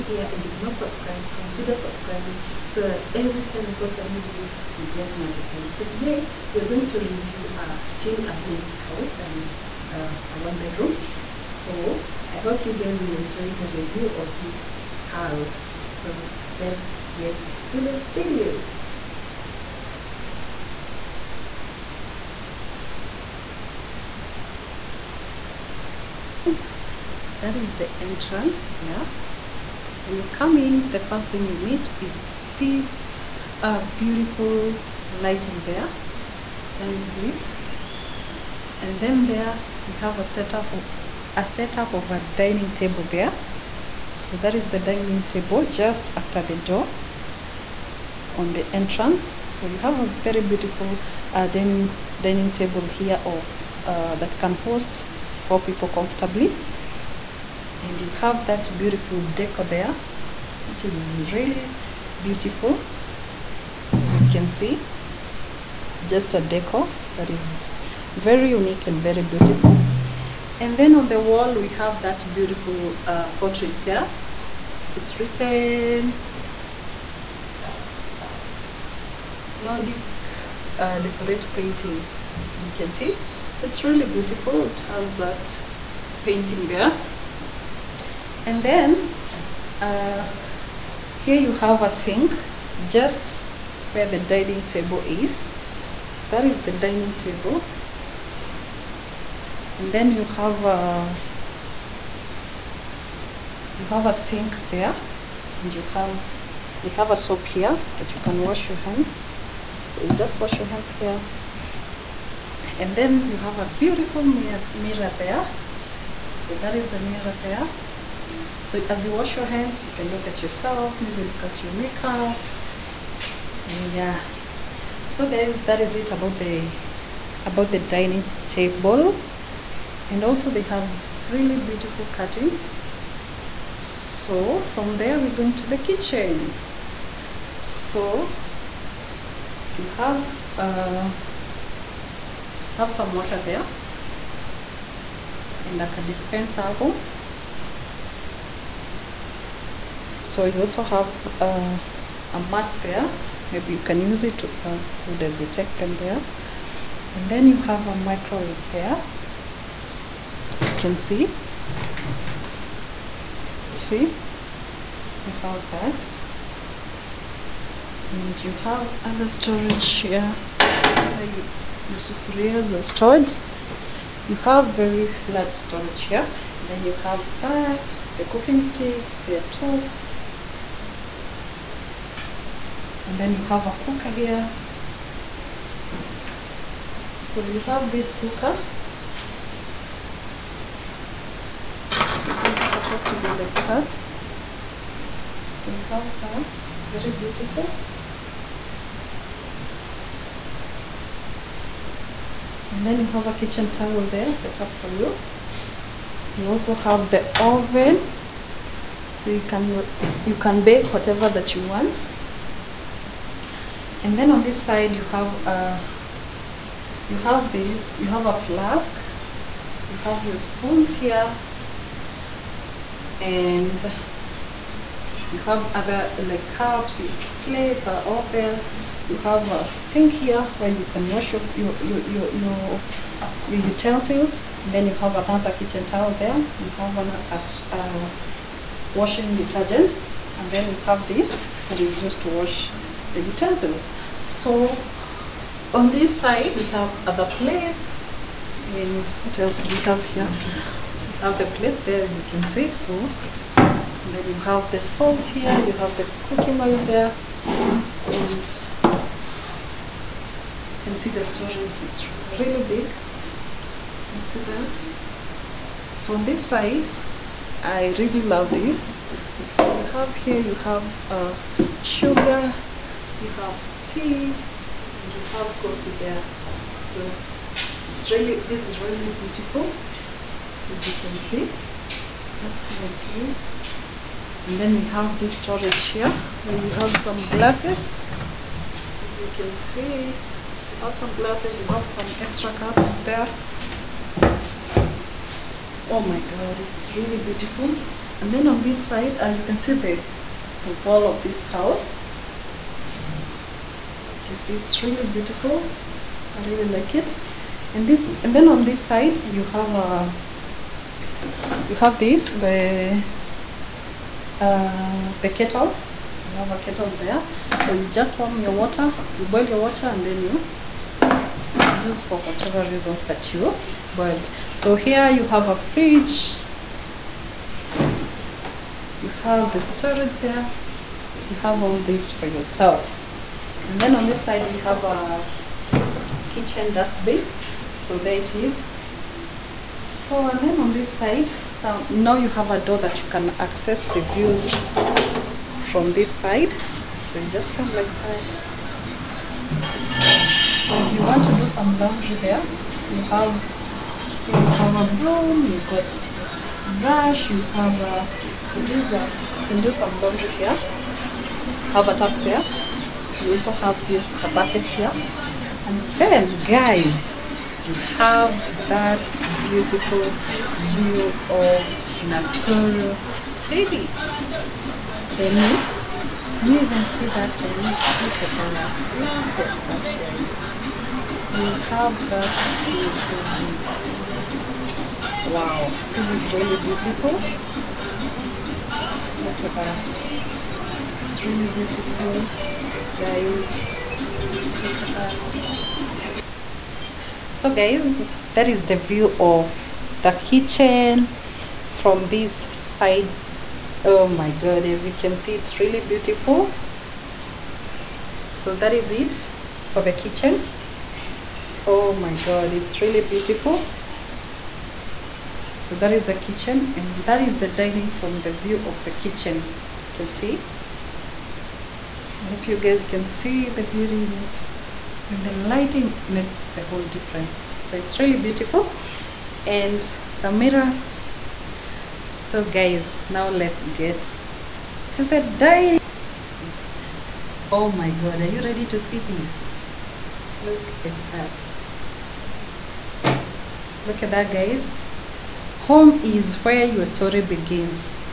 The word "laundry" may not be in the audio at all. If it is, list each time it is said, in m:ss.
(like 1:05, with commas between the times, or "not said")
5:51, 6:00.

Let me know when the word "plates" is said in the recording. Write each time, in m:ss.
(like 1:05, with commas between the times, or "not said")
3:47, 4:07, 4:11.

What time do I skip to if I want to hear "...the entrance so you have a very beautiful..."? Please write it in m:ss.
0:48.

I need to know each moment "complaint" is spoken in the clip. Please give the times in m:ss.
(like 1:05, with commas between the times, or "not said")
not said.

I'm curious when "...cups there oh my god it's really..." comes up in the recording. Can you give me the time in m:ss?
4:52.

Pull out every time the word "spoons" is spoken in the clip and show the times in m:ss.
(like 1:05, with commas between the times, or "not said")
3:40.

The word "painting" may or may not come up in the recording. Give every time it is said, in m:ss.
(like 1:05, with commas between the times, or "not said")
1:21, 1:26.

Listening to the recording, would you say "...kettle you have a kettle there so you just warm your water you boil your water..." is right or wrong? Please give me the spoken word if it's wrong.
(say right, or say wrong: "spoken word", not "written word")
right.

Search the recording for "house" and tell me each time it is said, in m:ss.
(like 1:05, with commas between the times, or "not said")
0:08, 0:15, 5:01.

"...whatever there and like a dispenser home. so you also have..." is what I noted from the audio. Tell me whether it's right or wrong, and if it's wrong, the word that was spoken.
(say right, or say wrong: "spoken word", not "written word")
wrong: "water", not "whatever".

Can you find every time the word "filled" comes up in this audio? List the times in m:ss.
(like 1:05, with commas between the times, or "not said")
not said.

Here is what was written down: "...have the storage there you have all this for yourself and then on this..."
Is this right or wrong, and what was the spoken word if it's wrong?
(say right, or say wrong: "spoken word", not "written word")
right.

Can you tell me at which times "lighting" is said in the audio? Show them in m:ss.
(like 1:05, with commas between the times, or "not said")
0:35, 7:05.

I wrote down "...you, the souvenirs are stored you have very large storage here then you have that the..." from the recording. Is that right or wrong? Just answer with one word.
right.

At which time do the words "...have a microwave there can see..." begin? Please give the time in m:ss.
2:37.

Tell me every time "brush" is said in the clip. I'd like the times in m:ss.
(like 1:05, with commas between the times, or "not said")
5:56.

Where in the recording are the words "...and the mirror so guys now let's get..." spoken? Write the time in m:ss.
7:09.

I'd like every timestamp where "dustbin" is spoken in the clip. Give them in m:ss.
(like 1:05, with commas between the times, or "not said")
5:36.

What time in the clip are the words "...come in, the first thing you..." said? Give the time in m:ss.
0:30.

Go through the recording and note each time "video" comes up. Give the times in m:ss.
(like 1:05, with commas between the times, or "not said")
0:04, 0:18.